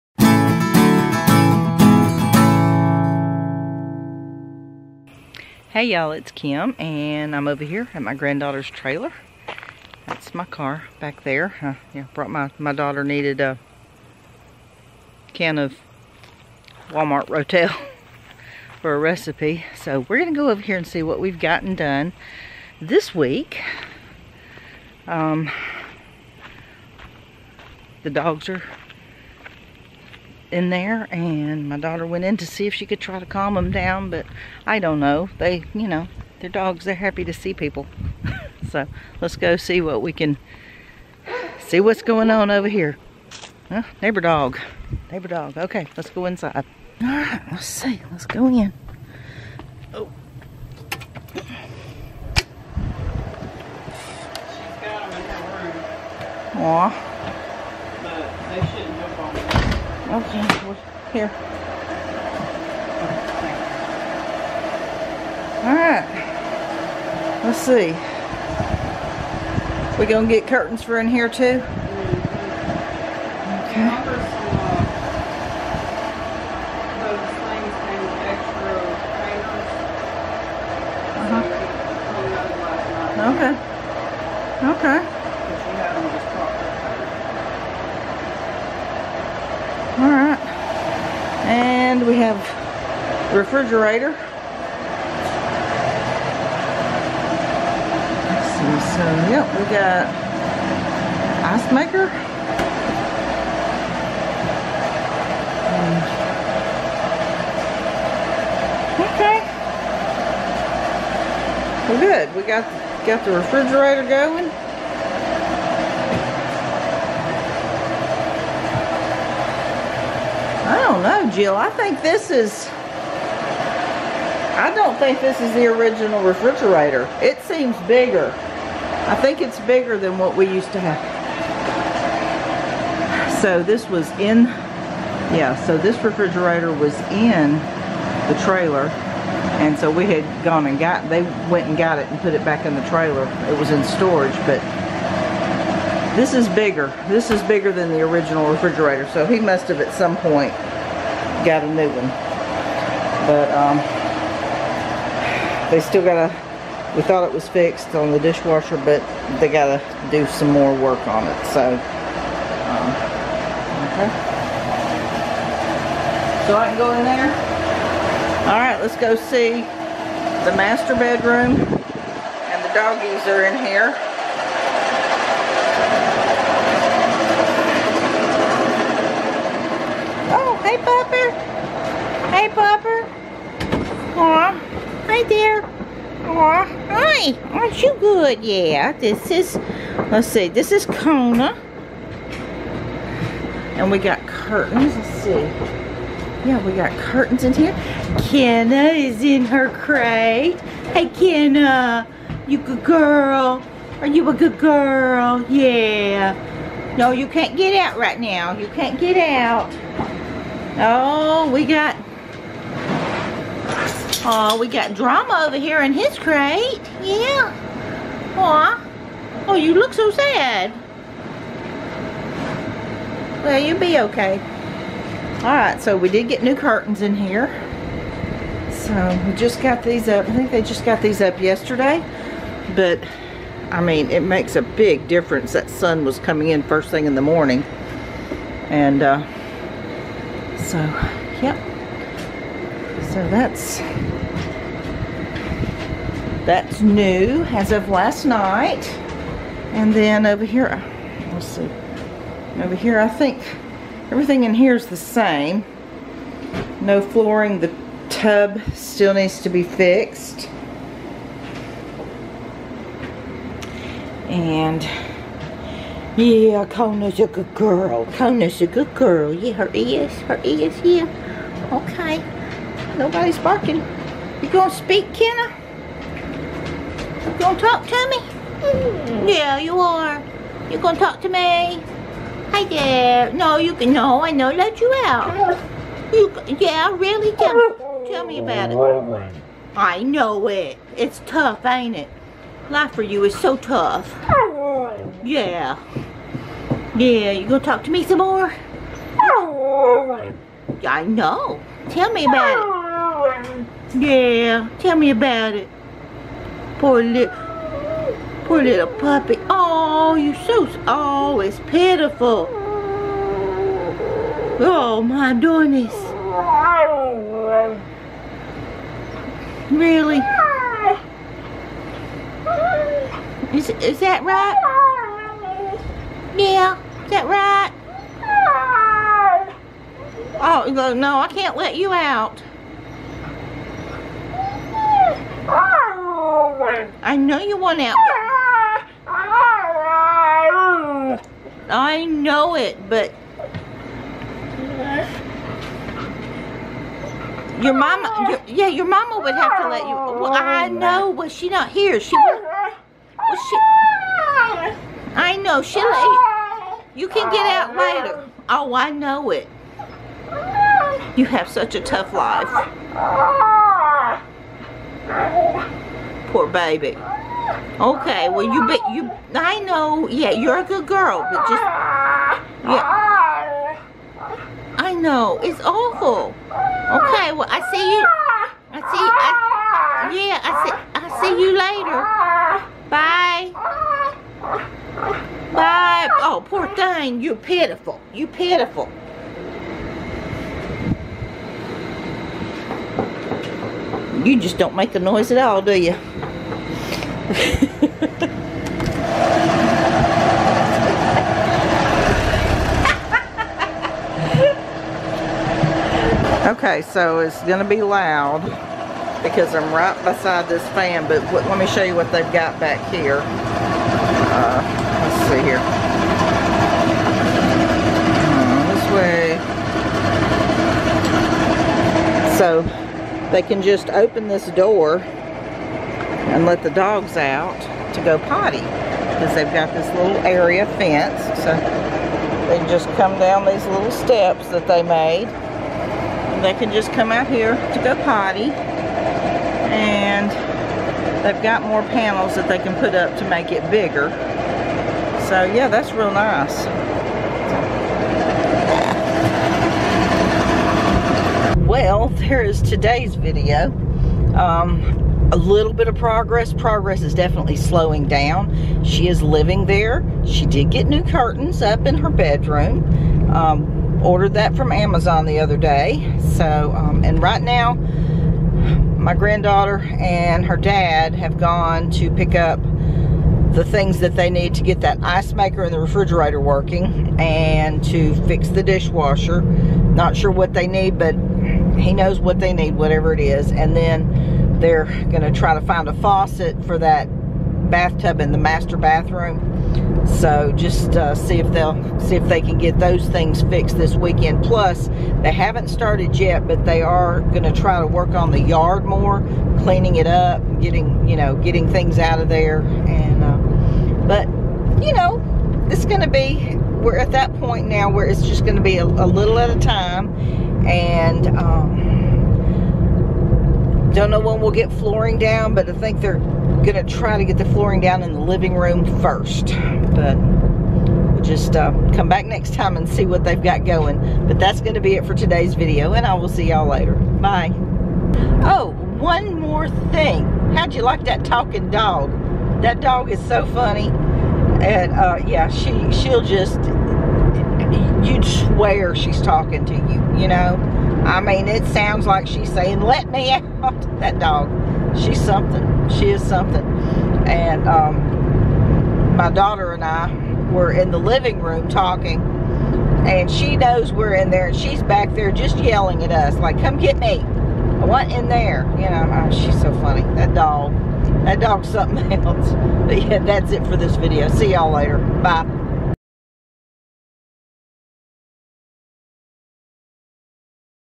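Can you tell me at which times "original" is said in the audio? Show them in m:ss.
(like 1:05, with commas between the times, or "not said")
2:05, 2:28.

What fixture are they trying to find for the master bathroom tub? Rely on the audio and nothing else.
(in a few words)
a faucet.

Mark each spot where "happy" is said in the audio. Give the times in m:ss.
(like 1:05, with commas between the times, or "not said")
0:36.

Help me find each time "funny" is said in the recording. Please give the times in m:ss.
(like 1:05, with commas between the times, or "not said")
8:53, 9:19.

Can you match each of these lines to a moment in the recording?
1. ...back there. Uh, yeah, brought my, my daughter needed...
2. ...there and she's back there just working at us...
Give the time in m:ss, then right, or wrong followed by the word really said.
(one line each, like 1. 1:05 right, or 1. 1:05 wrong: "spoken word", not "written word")
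1. 0:10 right
2. 9:14 wrong: "yelling", not "working".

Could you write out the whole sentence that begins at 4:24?
And yeah, Kona's a good girl.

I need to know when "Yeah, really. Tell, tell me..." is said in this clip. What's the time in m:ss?
4:46.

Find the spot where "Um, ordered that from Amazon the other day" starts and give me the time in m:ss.
7:43.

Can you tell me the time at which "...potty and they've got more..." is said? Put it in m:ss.
7:18.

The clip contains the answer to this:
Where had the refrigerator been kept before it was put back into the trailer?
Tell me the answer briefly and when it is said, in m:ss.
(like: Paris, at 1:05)
in storage, at 2:23.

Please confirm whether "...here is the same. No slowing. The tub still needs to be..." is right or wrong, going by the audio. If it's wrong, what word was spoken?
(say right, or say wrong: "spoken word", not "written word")
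wrong: "flooring", not "slowing".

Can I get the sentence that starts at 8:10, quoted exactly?
So just uh, see if they'll see if they can get those things fixed this weekend.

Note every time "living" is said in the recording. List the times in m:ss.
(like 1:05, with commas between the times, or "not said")
7:39, 8:38, 9:10.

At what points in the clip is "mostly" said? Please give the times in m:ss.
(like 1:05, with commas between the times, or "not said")
not said.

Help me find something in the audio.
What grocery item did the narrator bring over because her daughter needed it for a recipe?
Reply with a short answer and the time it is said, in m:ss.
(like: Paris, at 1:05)
Rotel, at 0:16.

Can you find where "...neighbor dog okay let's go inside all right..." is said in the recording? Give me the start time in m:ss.
0:45.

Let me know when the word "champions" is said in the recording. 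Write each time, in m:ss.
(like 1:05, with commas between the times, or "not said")
not said.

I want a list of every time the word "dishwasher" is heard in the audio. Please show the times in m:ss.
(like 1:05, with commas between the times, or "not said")
2:38, 7:58.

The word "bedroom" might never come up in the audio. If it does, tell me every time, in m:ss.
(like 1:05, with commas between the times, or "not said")
2:50, 7:42.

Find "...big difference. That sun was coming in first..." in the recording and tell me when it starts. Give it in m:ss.
3:54.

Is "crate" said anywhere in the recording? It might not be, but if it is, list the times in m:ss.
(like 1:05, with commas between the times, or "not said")
3:19, 3:36.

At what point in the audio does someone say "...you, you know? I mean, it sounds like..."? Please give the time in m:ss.
8:59.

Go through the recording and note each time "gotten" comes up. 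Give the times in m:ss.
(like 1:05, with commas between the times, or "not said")
0:21.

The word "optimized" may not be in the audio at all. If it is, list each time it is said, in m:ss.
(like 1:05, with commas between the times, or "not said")
not said.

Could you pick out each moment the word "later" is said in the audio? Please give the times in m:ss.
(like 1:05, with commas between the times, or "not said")
5:57, 6:21, 8:46, 9:24.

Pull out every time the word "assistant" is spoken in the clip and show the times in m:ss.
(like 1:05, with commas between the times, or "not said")
not said.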